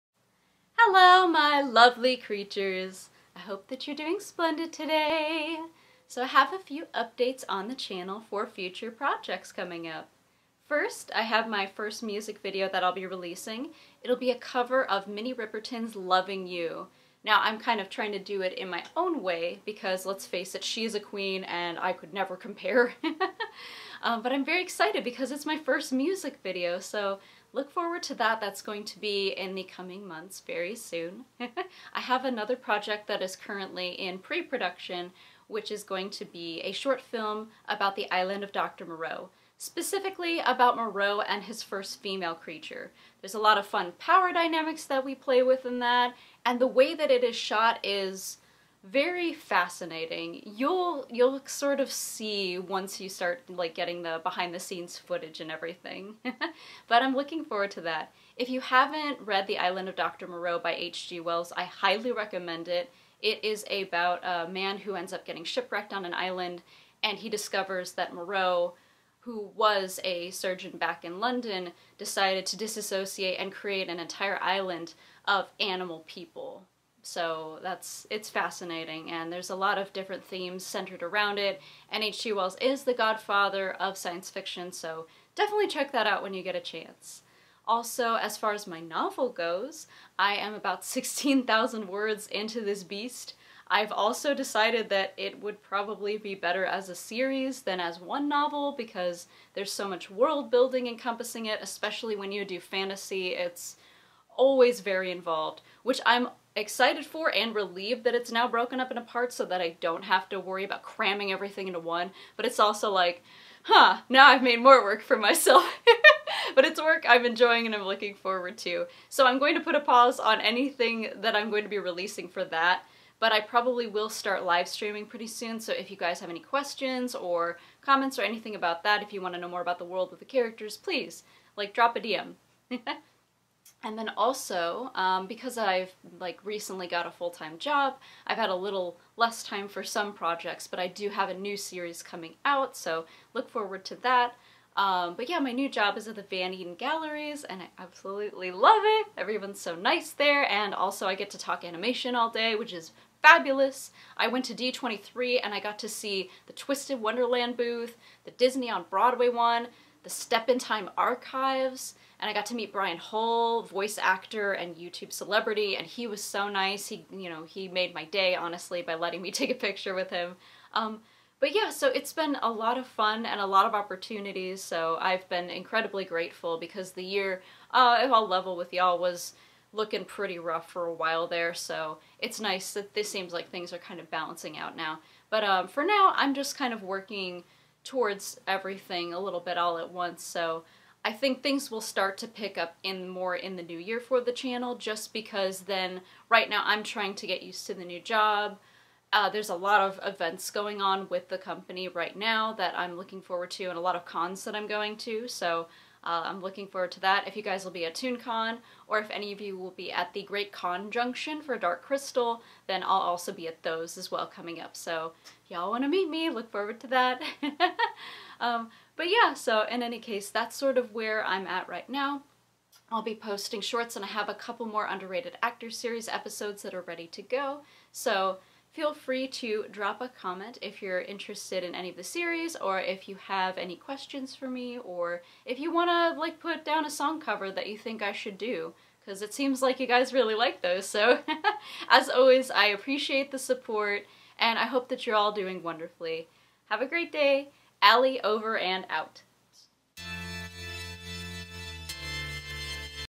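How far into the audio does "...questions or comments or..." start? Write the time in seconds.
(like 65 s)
126 s.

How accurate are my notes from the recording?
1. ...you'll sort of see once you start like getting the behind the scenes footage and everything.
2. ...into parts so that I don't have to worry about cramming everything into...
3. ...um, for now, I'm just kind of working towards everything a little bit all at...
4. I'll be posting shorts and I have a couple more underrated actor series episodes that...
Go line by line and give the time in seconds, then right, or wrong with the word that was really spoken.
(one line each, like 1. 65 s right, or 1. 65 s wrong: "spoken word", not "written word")
1. 51 s right
2. 108 s right
3. 185 s right
4. 222 s right.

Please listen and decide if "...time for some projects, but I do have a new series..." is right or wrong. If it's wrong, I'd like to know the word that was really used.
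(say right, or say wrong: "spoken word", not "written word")
right.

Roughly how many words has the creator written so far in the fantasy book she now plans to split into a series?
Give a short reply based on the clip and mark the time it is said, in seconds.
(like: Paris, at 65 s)
16,000, at 90 s.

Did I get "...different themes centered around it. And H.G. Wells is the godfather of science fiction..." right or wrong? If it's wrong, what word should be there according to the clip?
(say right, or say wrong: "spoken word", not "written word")
right.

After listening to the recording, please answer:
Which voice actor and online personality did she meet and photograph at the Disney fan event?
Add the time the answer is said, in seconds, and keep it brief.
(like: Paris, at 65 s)
Brian Hull, at 162 s.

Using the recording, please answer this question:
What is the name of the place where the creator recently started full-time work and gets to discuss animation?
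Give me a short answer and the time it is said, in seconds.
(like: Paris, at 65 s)
Van Eaton Galleries, at 146 s.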